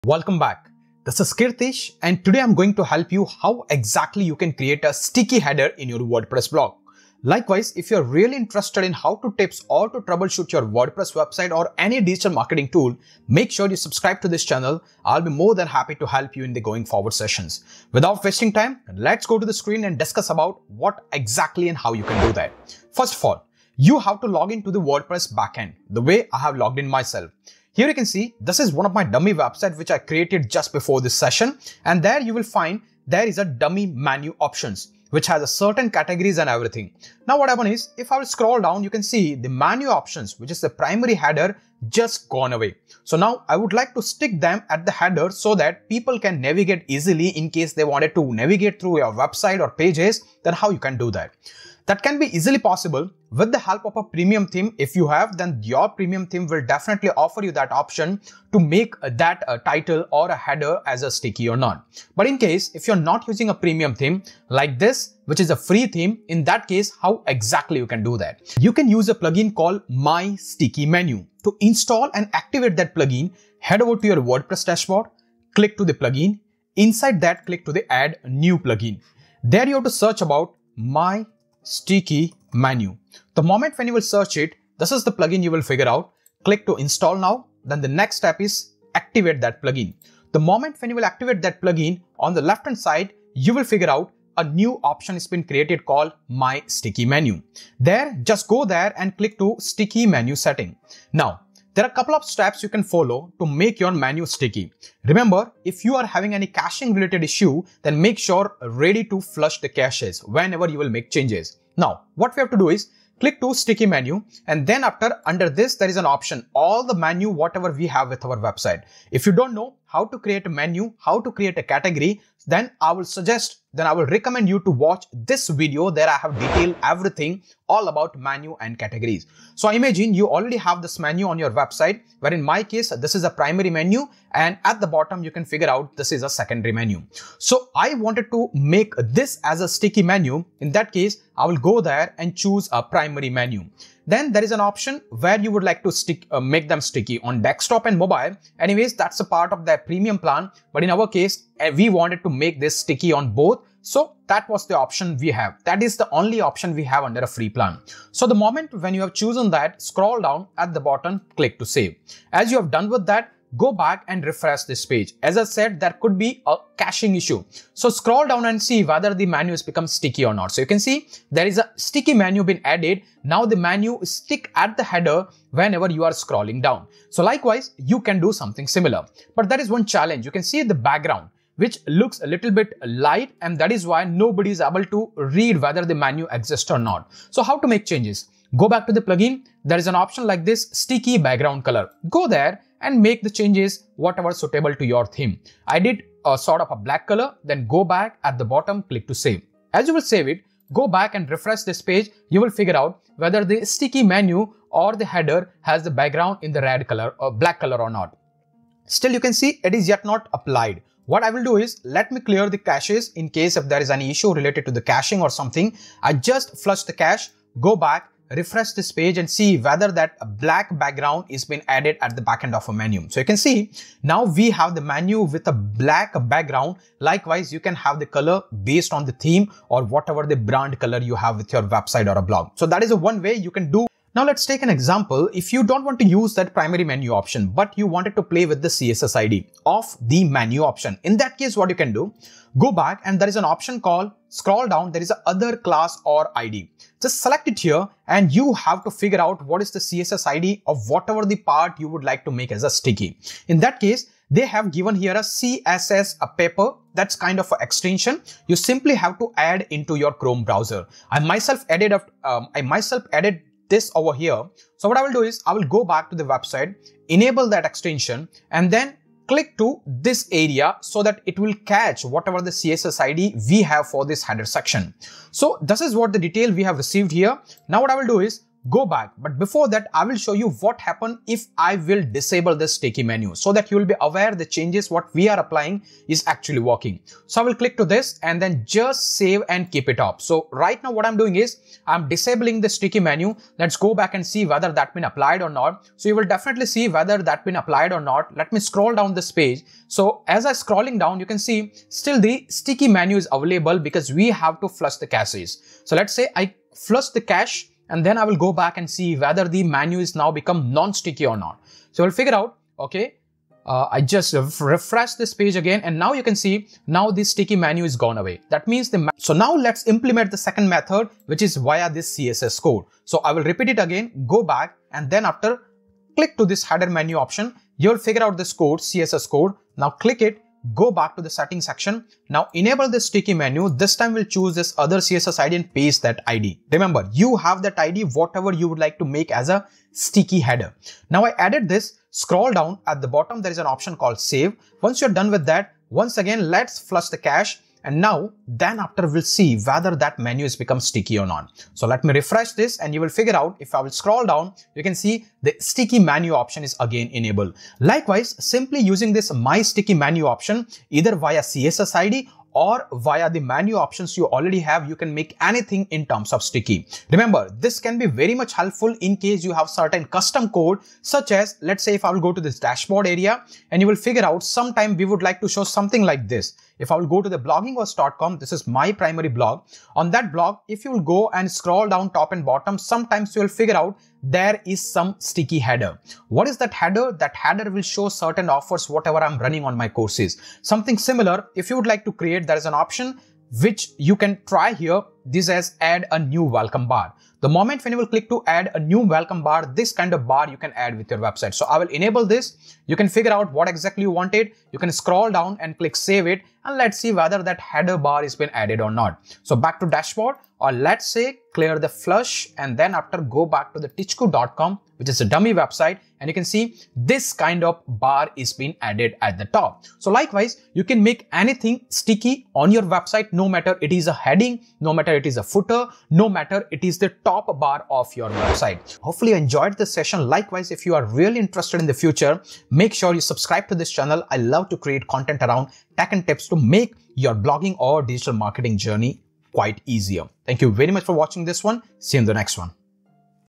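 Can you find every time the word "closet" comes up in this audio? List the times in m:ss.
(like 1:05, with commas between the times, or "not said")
not said.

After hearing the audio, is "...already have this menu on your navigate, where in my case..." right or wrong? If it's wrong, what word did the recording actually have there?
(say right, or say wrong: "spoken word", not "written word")
wrong: "website", not "navigate".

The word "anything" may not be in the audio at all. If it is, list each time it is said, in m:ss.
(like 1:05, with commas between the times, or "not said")
6:05, 7:01.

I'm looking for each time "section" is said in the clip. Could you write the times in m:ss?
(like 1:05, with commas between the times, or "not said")
4:34, 5:31.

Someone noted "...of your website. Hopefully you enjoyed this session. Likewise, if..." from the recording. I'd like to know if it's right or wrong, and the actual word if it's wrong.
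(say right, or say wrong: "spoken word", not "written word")
right.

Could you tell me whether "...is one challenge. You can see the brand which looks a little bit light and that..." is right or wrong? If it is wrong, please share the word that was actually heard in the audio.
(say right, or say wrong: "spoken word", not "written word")
wrong: "background", not "brand".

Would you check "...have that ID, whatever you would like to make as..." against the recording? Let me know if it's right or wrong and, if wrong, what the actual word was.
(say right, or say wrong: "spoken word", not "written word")
right.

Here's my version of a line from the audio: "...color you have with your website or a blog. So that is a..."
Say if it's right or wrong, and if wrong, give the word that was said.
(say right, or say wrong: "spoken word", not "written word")
right.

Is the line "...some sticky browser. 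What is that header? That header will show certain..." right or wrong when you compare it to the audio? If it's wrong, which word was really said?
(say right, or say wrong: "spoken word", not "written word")
wrong: "header", not "browser".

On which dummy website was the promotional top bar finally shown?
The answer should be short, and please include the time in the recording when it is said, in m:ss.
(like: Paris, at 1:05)
tichku.com, at 6:53.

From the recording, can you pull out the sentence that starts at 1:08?
You can use a plugin called My Sticky Menu.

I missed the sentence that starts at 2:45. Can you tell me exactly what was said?
As I said, there could be a caching issue.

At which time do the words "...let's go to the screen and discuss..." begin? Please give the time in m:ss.
0:18.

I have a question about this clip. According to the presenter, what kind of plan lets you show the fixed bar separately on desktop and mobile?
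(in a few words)
premium plan.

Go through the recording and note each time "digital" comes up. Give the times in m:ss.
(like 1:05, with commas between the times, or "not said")
0:12, 7:18.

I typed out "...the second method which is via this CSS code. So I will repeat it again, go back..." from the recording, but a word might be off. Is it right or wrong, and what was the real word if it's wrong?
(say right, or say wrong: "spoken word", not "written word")
right.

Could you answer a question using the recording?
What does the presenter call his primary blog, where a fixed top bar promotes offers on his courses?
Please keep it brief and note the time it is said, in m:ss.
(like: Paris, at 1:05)
bloggingos.com, at 6:17.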